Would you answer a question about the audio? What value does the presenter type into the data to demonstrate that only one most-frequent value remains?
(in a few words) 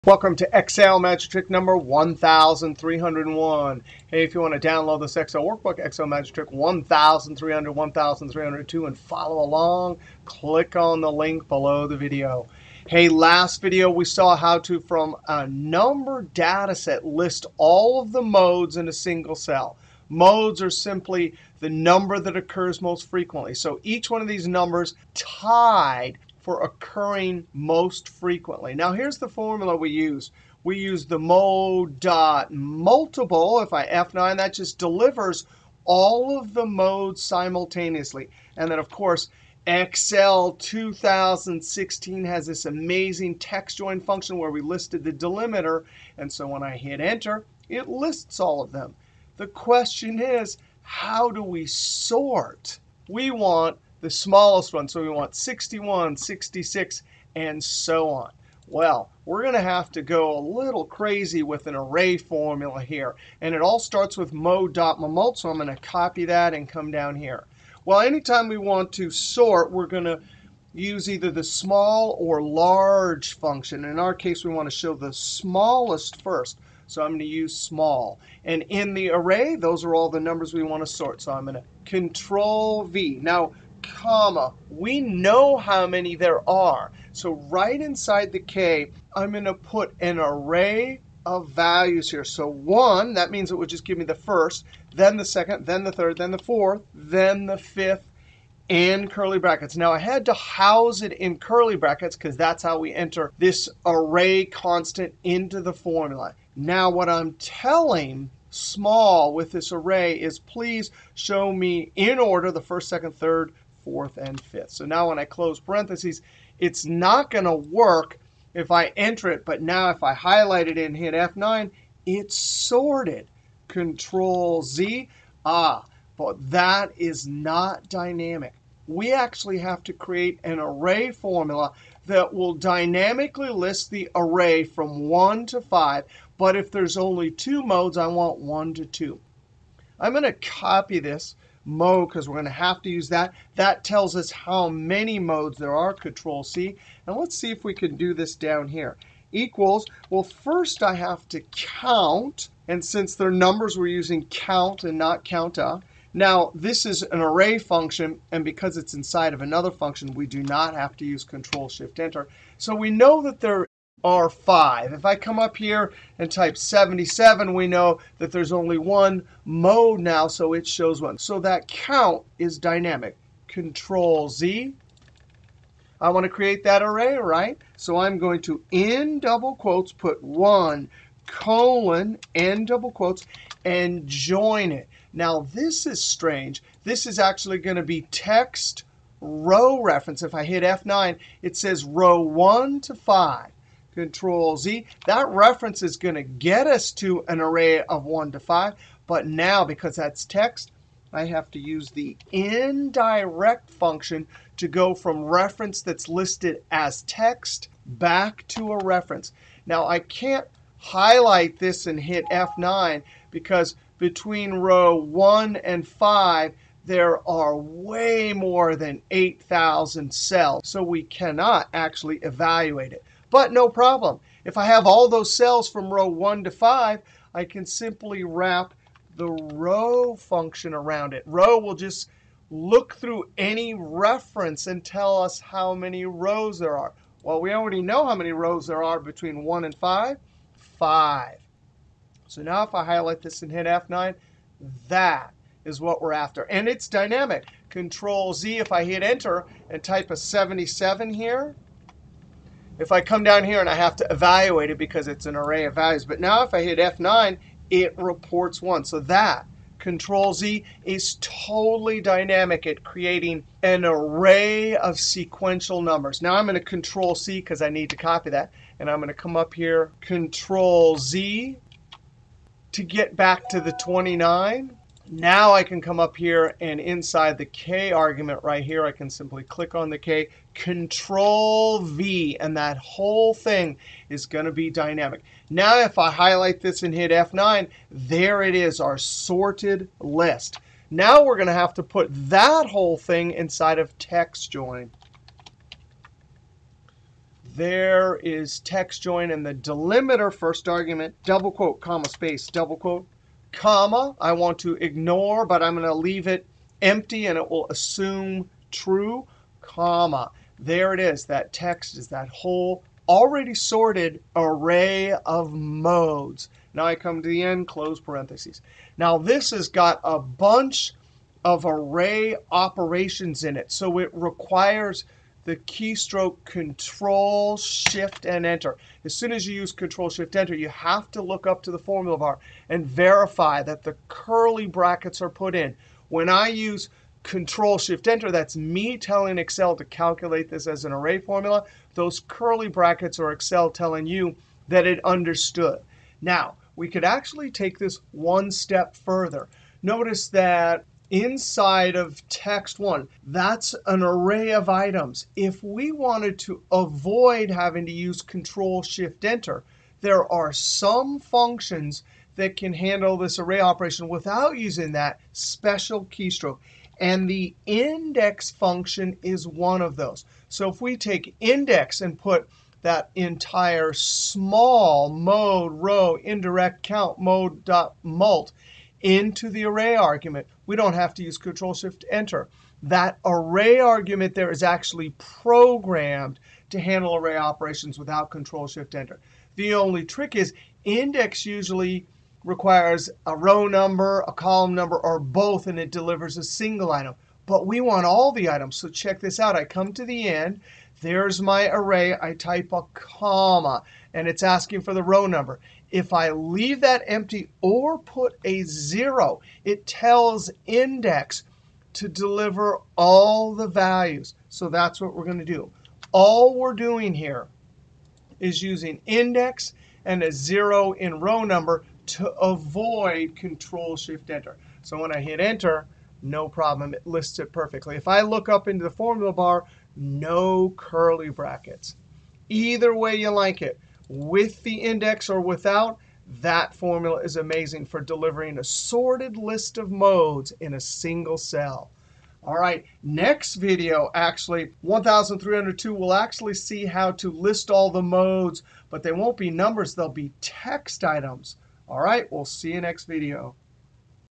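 77.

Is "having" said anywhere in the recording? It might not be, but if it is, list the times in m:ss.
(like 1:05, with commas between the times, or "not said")
5:57.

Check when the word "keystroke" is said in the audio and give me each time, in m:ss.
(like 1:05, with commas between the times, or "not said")
5:25, 6:06.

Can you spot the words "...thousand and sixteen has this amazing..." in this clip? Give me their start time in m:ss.
0:40.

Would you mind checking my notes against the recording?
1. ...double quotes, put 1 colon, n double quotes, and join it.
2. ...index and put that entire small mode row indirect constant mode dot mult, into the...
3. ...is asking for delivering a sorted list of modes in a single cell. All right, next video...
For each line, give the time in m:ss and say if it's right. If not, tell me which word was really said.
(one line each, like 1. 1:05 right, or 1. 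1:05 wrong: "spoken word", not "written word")
1. 2:59 right
2. 6:11 wrong: "count", not "constant"
3. 7:17 wrong: "amazing", not "asking".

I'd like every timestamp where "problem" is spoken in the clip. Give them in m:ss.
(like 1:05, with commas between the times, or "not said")
3:43, 7:06.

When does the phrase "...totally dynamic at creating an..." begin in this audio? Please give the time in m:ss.
4:21.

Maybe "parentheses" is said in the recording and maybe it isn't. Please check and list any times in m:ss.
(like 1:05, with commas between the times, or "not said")
1:55, 5:17.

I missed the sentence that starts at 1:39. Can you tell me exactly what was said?
now, i had to house it in curly brackets because that's how we enter this array constant into the formula.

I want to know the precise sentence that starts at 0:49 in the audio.
the question is how do we sort?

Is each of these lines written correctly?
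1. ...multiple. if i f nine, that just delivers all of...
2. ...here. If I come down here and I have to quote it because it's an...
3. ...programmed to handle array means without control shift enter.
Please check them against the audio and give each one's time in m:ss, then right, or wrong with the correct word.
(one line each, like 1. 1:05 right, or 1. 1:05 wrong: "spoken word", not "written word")
1. 0:32 right
2. 4:11 wrong: "evaluate", not "quote"
3. 6:25 wrong: "operations", not "means".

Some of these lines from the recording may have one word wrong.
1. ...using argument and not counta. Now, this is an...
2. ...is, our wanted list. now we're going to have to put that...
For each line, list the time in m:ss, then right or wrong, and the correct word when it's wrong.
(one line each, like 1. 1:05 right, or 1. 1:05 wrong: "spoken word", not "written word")
1. 2:33 wrong: "count", not "argument"
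2. 4:48 wrong: "sorted", not "wanted".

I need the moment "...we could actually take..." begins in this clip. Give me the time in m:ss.
5:46.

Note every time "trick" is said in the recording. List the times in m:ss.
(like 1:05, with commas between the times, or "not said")
0:01, 0:06, 6:30.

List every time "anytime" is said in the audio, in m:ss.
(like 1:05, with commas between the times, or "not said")
1:07.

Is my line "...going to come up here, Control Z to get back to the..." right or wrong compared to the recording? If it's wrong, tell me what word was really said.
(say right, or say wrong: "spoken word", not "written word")
right.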